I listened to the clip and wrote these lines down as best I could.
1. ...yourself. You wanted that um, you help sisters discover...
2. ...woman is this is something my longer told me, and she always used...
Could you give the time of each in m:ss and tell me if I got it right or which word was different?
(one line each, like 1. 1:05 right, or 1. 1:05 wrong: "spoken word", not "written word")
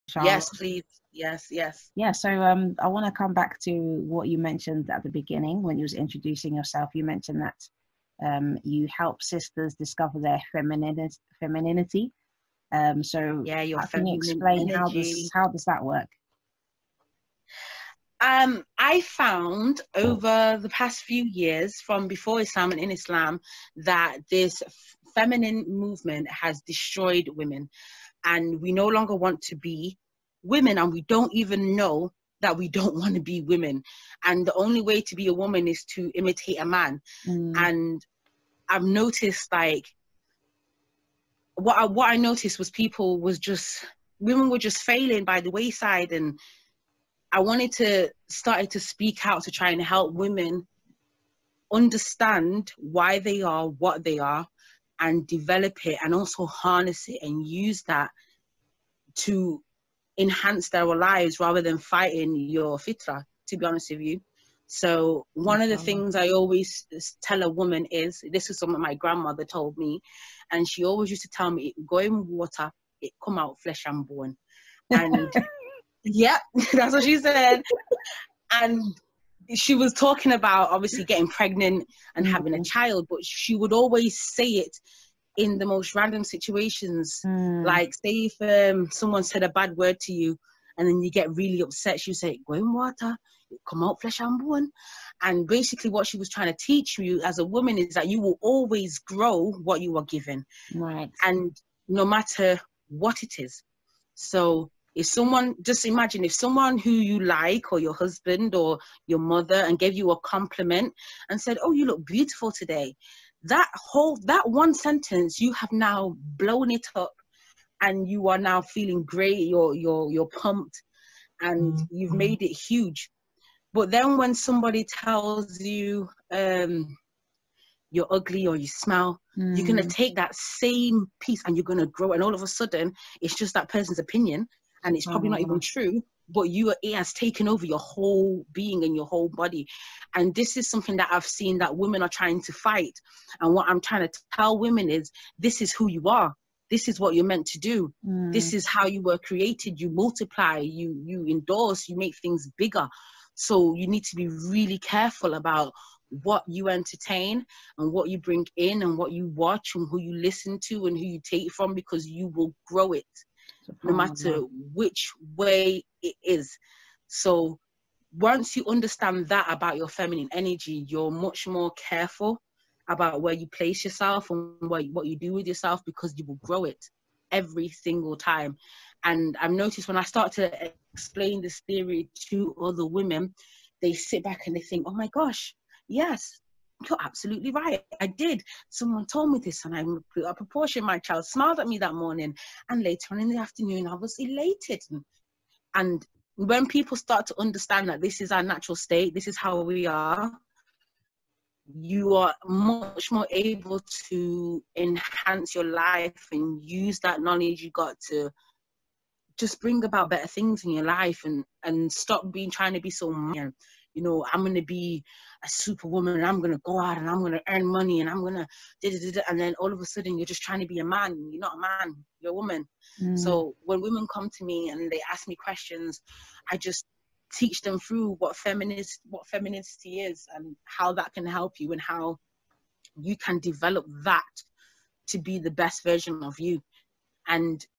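1. 0:06 wrong: "mentioned", not "wanted"
2. 1:07 wrong: "grandmother", not "longer".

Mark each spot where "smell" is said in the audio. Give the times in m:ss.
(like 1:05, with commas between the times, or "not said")
2:08.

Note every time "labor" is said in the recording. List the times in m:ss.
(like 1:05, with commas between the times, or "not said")
not said.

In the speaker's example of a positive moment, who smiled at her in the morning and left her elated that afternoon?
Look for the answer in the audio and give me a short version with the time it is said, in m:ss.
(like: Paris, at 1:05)
My child, at 3:10.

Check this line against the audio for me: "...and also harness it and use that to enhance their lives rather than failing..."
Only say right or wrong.
wrong.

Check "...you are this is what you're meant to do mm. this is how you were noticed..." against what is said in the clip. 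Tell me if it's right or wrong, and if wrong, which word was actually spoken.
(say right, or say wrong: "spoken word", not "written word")
wrong: "created", not "noticed".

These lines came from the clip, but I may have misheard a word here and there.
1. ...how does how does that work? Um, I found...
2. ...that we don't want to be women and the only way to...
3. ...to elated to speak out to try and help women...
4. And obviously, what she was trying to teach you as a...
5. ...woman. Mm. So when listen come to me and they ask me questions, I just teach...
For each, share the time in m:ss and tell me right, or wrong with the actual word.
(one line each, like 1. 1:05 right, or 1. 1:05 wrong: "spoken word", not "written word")
1. 0:14 right
2. 0:32 right
3. 0:47 wrong: "started", not "elated"
4. 1:35 wrong: "basically", not "obviously"
5. 3:42 wrong: "women", not "listen".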